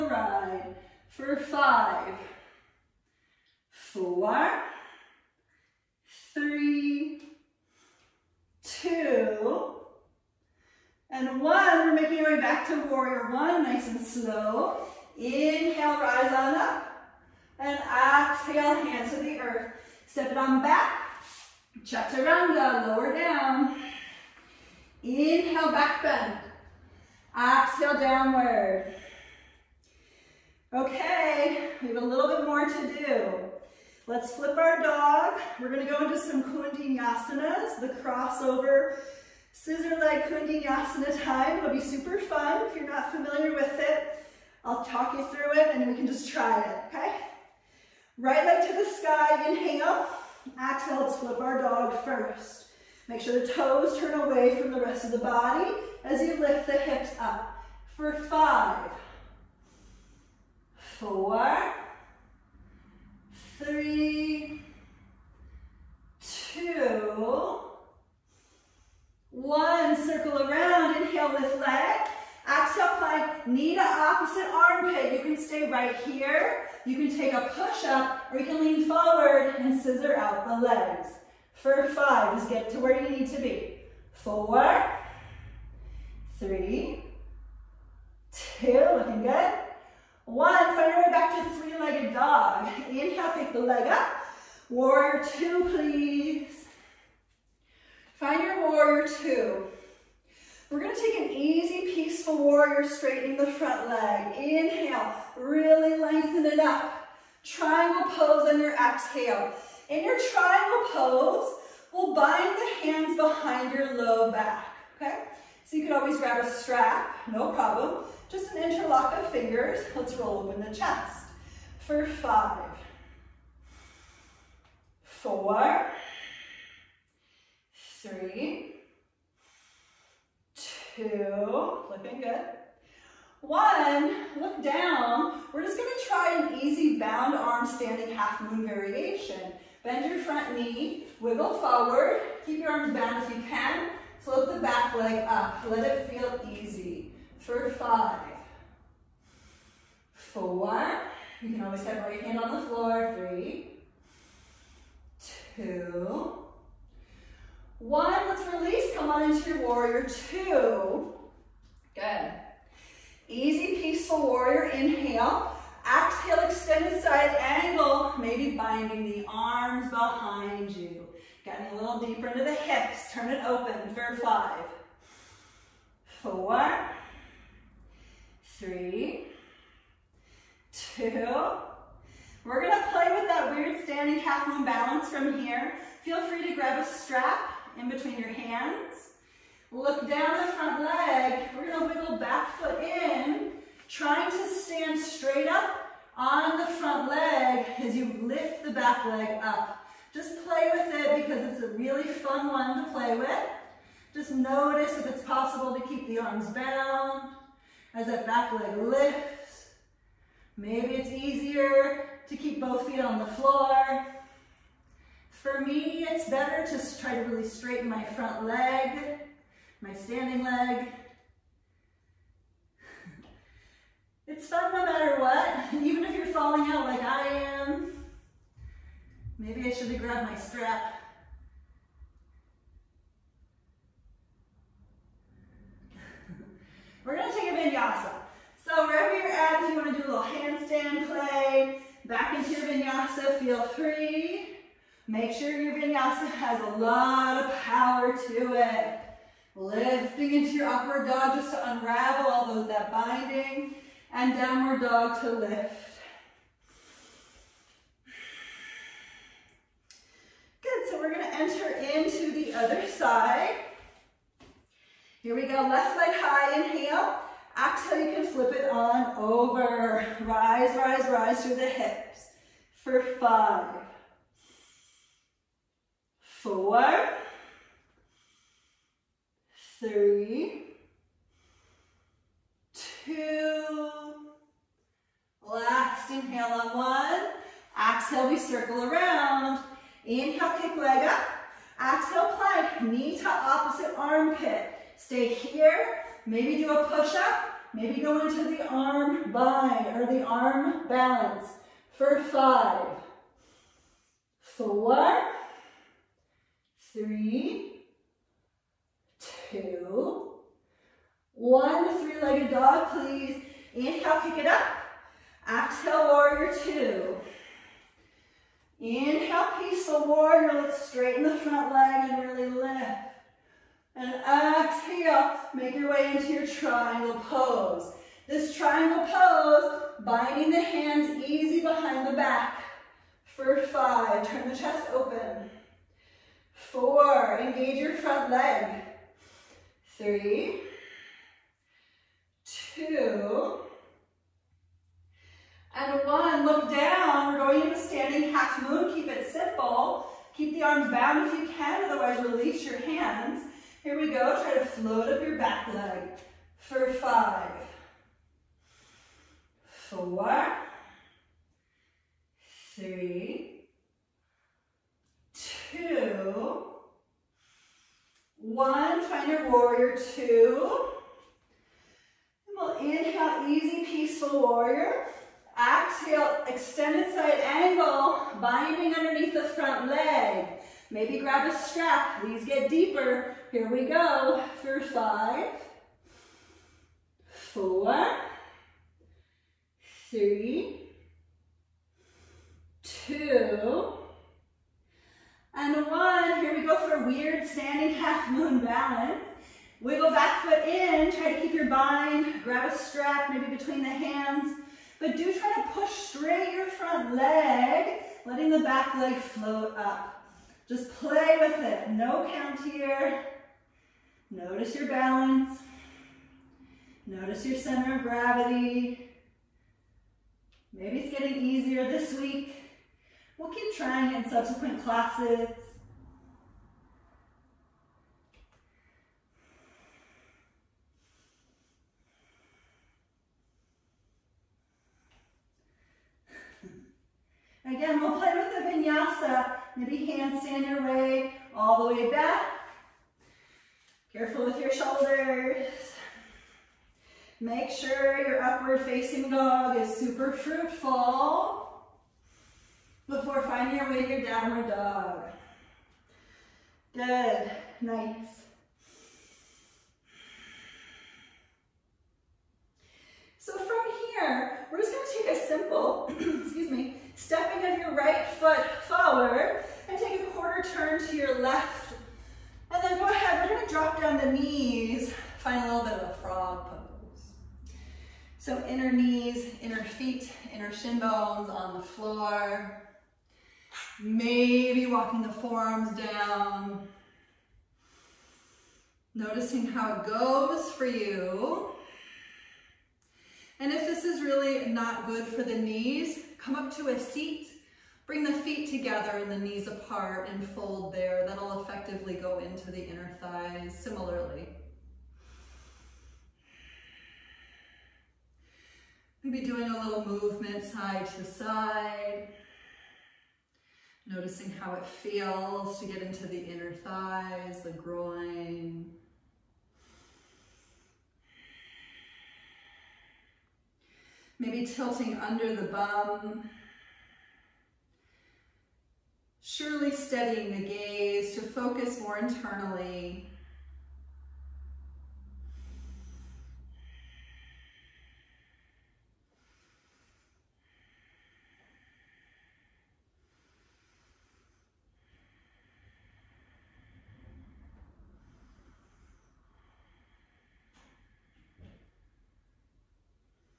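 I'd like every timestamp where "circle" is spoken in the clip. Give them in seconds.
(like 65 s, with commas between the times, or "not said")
69 s, 288 s.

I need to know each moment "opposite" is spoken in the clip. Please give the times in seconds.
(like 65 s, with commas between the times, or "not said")
73 s, 293 s.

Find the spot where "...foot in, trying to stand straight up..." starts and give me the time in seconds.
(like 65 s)
192 s.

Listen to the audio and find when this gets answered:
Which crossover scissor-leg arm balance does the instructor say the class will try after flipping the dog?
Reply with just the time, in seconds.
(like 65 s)
36 s.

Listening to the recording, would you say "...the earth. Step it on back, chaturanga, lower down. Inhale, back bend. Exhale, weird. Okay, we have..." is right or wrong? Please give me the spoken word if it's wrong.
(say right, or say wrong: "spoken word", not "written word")
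wrong: "downward", not "weird".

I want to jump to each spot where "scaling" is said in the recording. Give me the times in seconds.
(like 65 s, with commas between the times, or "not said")
not said.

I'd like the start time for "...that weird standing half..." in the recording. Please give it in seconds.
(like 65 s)
183 s.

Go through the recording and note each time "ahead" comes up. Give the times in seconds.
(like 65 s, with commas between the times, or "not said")
473 s.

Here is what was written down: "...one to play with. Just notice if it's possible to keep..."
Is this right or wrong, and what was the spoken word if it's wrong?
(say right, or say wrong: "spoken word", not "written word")
right.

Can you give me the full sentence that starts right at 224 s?
It's fun no matter what, even if you're falling out like I am.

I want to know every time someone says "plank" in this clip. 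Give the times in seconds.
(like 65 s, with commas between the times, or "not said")
72 s, 292 s.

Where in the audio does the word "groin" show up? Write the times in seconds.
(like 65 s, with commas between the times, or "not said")
517 s.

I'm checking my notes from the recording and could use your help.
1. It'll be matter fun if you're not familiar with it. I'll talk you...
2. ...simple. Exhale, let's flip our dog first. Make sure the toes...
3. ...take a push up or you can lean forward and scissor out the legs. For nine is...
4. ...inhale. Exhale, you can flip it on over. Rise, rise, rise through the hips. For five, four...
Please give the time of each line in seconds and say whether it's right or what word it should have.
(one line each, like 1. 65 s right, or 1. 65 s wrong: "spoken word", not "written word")
1. 41 s wrong: "super", not "matter"
2. 49 s wrong: "inhale", not "simple"
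3. 77 s wrong: "five", not "nine"
4. 266 s right.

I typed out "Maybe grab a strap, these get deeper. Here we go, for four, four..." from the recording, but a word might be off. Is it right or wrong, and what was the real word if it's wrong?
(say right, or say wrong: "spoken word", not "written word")
wrong: "five", not "four".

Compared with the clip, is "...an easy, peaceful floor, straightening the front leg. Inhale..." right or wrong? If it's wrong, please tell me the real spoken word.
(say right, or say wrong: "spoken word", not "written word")
wrong: "warrior", not "floor".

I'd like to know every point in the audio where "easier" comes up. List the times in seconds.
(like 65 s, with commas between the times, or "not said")
211 s, 421 s.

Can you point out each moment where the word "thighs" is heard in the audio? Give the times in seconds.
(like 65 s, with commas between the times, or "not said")
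503 s, 516 s.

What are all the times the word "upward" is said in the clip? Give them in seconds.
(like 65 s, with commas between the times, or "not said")
250 s, 448 s.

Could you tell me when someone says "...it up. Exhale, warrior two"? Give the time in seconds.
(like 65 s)
314 s.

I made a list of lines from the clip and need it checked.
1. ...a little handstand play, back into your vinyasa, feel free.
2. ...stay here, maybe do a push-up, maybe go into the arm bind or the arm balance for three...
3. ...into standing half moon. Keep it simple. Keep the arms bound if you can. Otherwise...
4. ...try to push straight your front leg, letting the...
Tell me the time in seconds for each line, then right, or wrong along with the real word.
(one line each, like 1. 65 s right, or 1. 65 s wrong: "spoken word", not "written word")
1. 239 s right
2. 294 s wrong: "five", not "three"
3. 347 s right
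4. 405 s right.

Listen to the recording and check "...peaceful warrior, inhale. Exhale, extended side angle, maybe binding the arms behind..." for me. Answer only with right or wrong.
right.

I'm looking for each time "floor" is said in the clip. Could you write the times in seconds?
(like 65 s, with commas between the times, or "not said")
152 s, 213 s, 481 s.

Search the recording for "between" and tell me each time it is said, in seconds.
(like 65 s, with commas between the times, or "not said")
187 s, 403 s.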